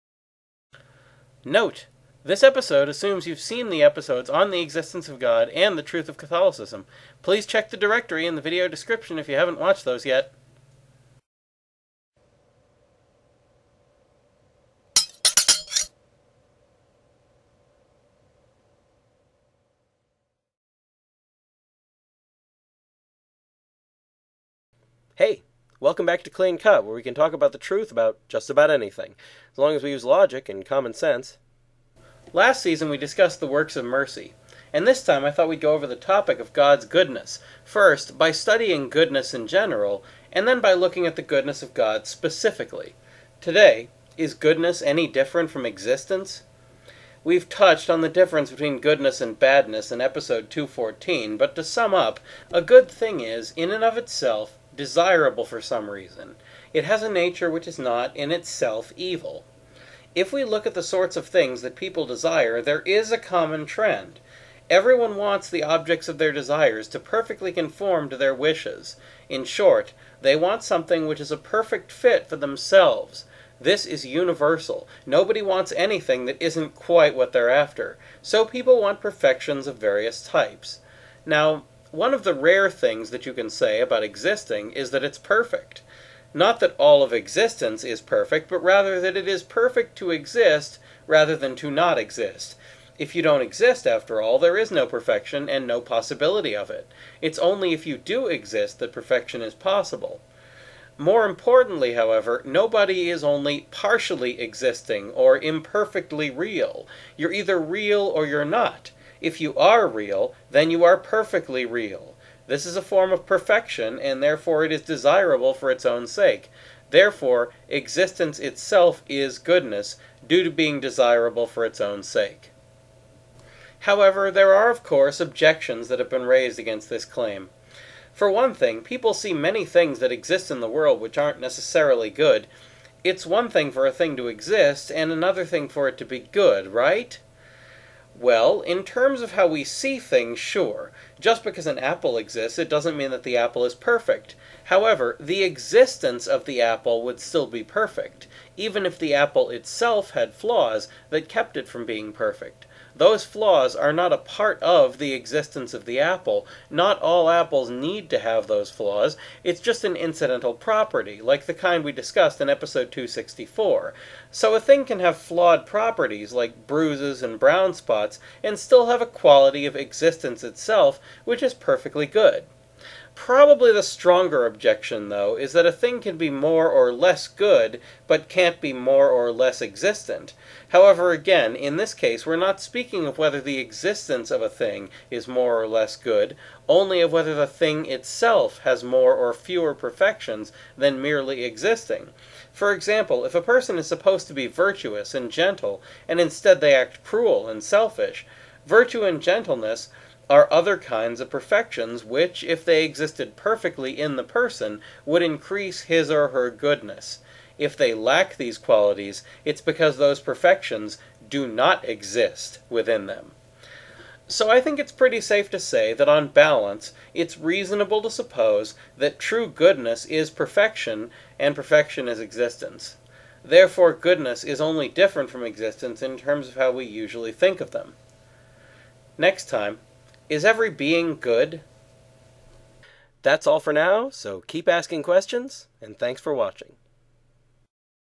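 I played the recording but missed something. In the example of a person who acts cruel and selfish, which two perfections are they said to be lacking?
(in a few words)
Virtue and gentleness.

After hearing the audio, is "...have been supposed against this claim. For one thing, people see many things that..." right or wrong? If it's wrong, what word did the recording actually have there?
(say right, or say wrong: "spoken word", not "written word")
wrong: "raised", not "supposed".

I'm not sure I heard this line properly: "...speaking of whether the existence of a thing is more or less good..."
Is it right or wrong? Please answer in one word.
right.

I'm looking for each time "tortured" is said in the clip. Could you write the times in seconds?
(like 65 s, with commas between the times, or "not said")
not said.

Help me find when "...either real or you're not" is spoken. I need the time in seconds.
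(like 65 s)
107 s.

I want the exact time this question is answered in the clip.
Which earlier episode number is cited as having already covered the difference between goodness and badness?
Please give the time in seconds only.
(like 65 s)
49 s.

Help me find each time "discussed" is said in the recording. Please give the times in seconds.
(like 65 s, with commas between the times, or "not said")
32 s, 161 s.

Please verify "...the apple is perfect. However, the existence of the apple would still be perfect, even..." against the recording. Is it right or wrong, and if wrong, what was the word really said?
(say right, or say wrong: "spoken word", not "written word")
right.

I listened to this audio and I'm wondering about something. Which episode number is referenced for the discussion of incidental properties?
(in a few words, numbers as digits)
264.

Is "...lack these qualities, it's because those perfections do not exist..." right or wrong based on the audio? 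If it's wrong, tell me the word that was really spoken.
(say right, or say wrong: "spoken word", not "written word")
right.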